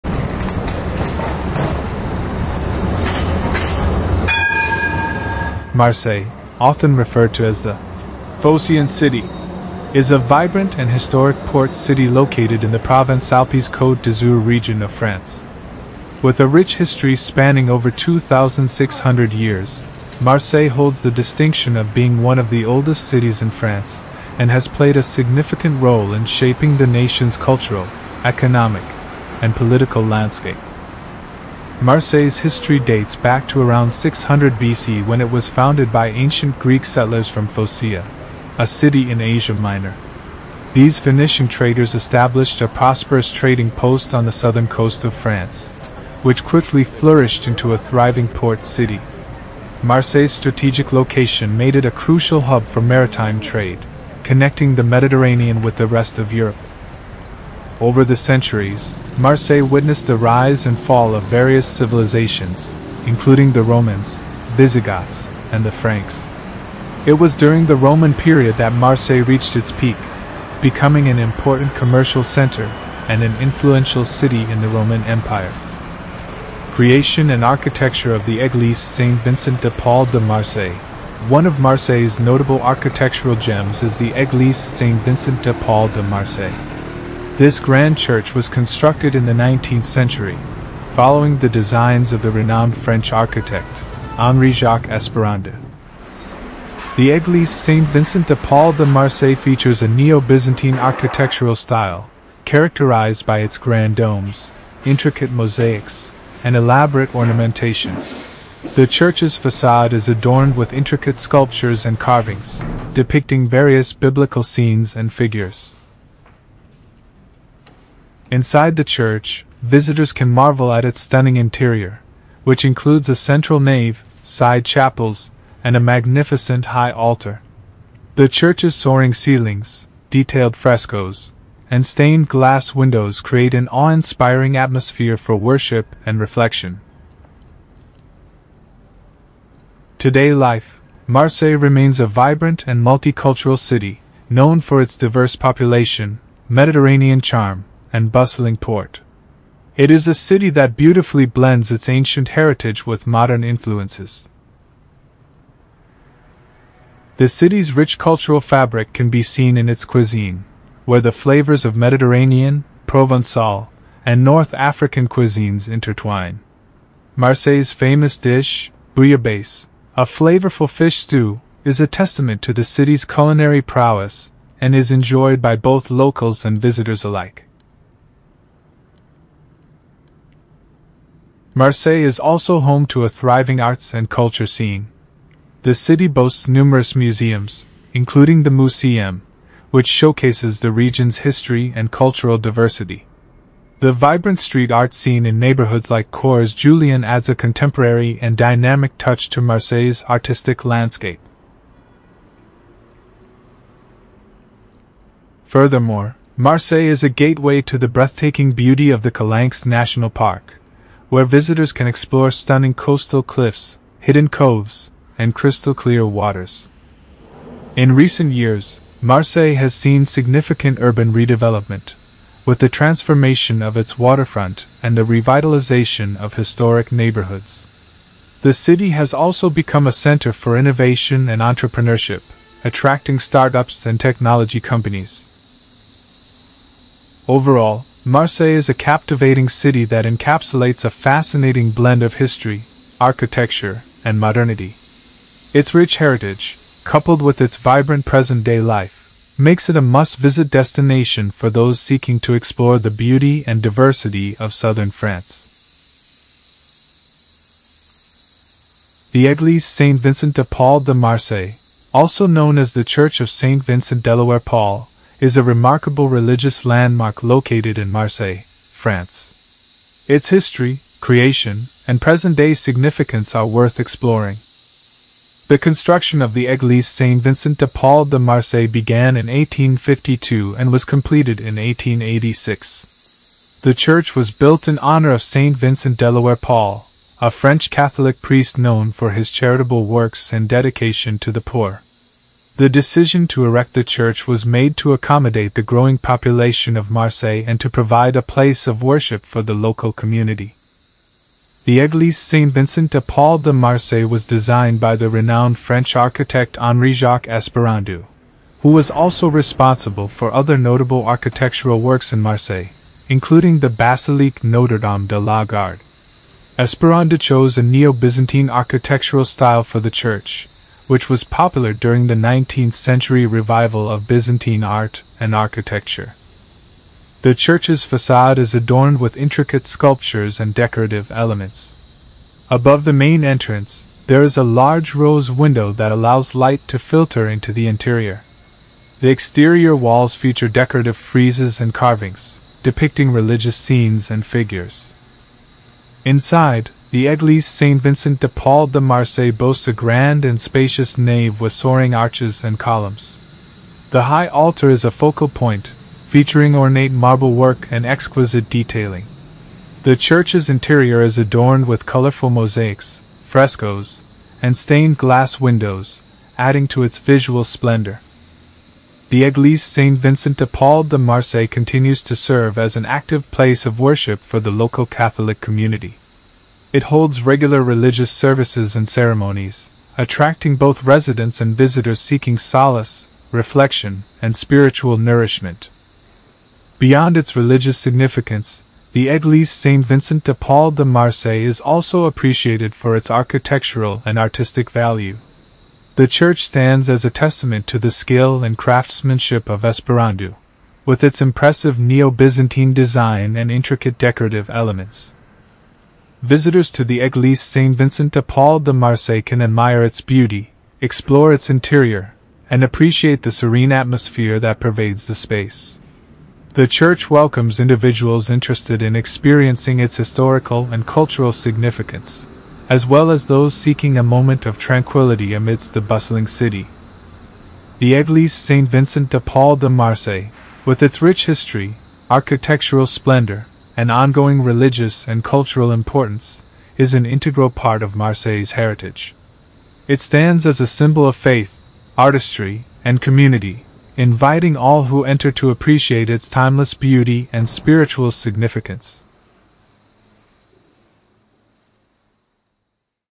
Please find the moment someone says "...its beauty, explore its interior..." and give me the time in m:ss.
6:49.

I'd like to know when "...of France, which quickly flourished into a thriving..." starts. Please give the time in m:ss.
0:45.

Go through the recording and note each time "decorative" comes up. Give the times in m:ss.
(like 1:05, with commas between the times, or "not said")
5:30, 5:40, 6:43.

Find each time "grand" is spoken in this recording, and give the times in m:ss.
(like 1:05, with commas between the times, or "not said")
1:27, 1:43, 5:49.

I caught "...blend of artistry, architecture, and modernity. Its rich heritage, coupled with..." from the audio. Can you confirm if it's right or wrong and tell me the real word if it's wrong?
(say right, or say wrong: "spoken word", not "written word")
wrong: "history", not "artistry".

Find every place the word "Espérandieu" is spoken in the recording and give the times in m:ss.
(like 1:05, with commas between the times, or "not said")
1:34, 5:07, 5:16, 6:39.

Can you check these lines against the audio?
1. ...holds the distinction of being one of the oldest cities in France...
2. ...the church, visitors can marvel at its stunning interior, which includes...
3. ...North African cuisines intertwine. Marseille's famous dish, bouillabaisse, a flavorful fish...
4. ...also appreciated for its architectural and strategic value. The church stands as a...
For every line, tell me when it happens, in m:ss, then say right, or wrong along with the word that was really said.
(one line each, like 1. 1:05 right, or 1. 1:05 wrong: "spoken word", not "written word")
1. 0:20 right
2. 1:58 right
3. 2:44 right
4. 6:31 wrong: "artistic", not "strategic".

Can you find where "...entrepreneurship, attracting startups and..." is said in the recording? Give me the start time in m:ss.
3:51.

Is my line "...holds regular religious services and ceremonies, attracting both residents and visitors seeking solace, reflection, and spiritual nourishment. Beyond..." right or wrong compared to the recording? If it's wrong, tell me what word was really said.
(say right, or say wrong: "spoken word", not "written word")
right.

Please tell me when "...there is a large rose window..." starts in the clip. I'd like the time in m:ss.
5:34.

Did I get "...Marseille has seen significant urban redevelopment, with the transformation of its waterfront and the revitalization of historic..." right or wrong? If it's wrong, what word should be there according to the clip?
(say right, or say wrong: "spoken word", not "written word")
right.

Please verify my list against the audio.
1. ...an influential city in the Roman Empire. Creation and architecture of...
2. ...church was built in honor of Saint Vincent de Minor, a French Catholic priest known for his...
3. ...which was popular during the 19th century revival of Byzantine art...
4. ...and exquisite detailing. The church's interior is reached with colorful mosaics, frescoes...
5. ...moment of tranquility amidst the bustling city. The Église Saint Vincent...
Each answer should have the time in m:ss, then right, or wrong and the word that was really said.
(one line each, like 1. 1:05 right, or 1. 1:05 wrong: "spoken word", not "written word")
1. 1:13 right
2. 4:43 wrong: "Paul", not "Minor"
3. 5:20 right
4. 5:57 wrong: "adorned", not "reached"
5. 7:04 right.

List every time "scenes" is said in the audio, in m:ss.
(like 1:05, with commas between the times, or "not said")
1:54, 3:04, 3:14, 5:43.